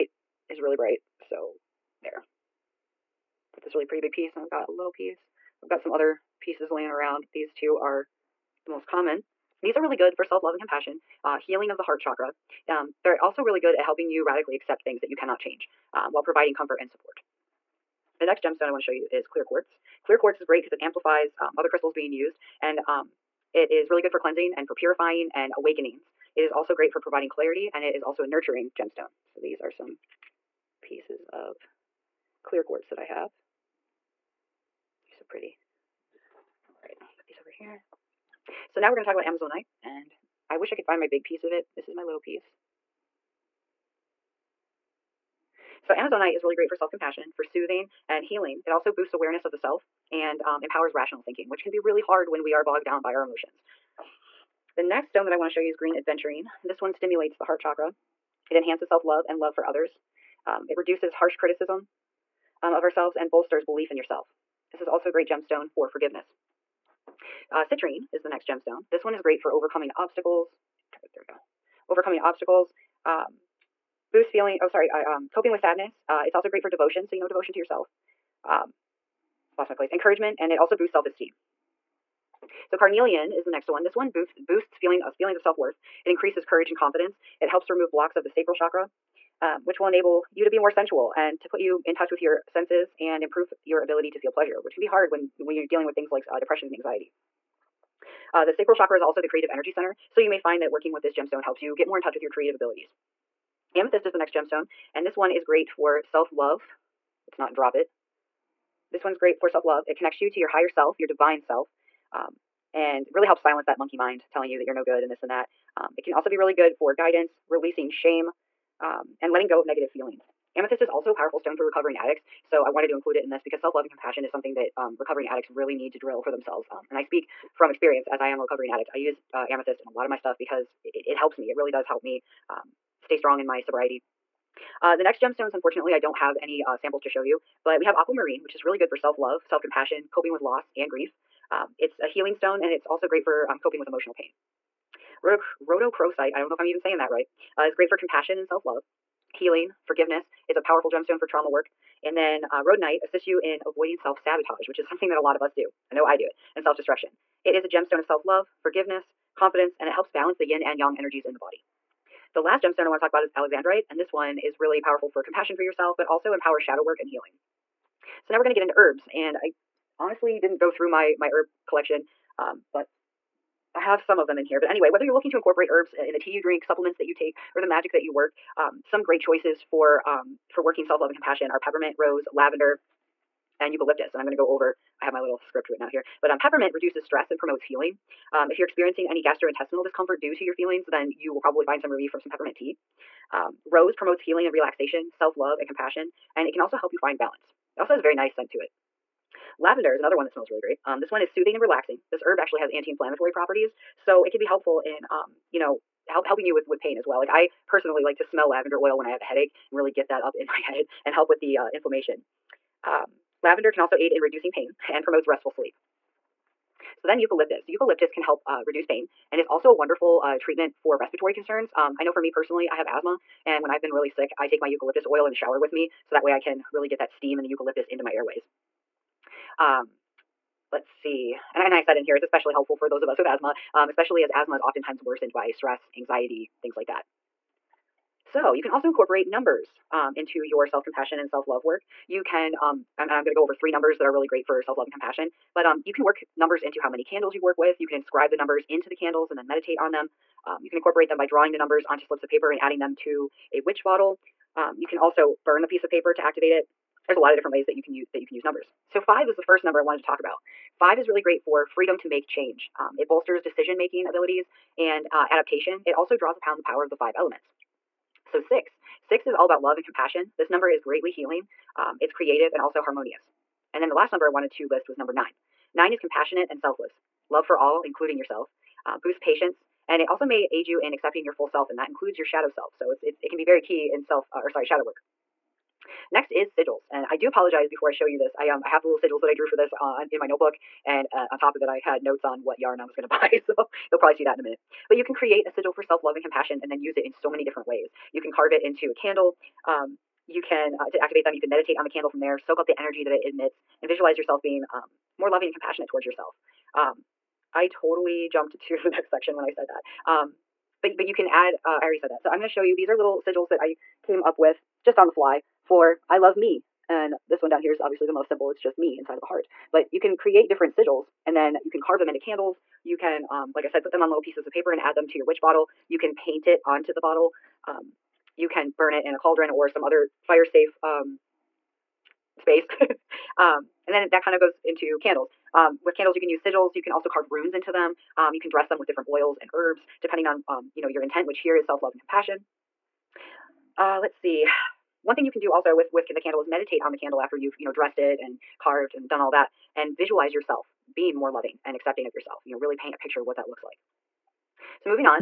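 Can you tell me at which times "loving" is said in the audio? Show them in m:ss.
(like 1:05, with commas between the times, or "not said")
5:05, 5:51.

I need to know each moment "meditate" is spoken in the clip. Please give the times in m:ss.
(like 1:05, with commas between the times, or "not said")
4:09, 5:01, 5:46.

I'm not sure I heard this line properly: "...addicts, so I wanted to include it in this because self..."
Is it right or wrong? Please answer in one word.
right.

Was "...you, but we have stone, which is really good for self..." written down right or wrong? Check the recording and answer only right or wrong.
wrong.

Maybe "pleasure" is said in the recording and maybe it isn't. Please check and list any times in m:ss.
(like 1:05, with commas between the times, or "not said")
1:34.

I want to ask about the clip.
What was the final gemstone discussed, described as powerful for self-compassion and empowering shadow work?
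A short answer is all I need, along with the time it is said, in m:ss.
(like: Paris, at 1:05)
Alexandrite, at 2:43.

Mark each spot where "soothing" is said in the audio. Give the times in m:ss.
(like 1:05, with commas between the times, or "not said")
0:47, 3:21.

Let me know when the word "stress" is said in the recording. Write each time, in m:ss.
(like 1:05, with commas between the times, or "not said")
3:07, 3:55.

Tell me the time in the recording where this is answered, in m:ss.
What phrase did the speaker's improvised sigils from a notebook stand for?
5:16.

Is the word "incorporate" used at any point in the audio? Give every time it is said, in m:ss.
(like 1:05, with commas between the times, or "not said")
2:55, 3:58, 4:10.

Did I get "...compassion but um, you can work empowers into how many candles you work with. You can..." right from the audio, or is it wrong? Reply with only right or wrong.
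wrong.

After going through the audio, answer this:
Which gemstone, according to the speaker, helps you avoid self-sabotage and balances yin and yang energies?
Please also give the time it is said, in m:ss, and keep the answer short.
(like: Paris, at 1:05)
Rhodonite, at 2:32.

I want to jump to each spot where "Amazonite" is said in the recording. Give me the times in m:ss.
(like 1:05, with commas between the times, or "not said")
0:39, 0:45.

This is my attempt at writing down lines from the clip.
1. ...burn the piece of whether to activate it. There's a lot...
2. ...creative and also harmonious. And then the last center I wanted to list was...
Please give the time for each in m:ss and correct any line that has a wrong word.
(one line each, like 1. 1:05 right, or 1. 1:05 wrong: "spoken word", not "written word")
1. 4:15 wrong: "paper", not "whether"
2. 4:32 wrong: "number", not "center".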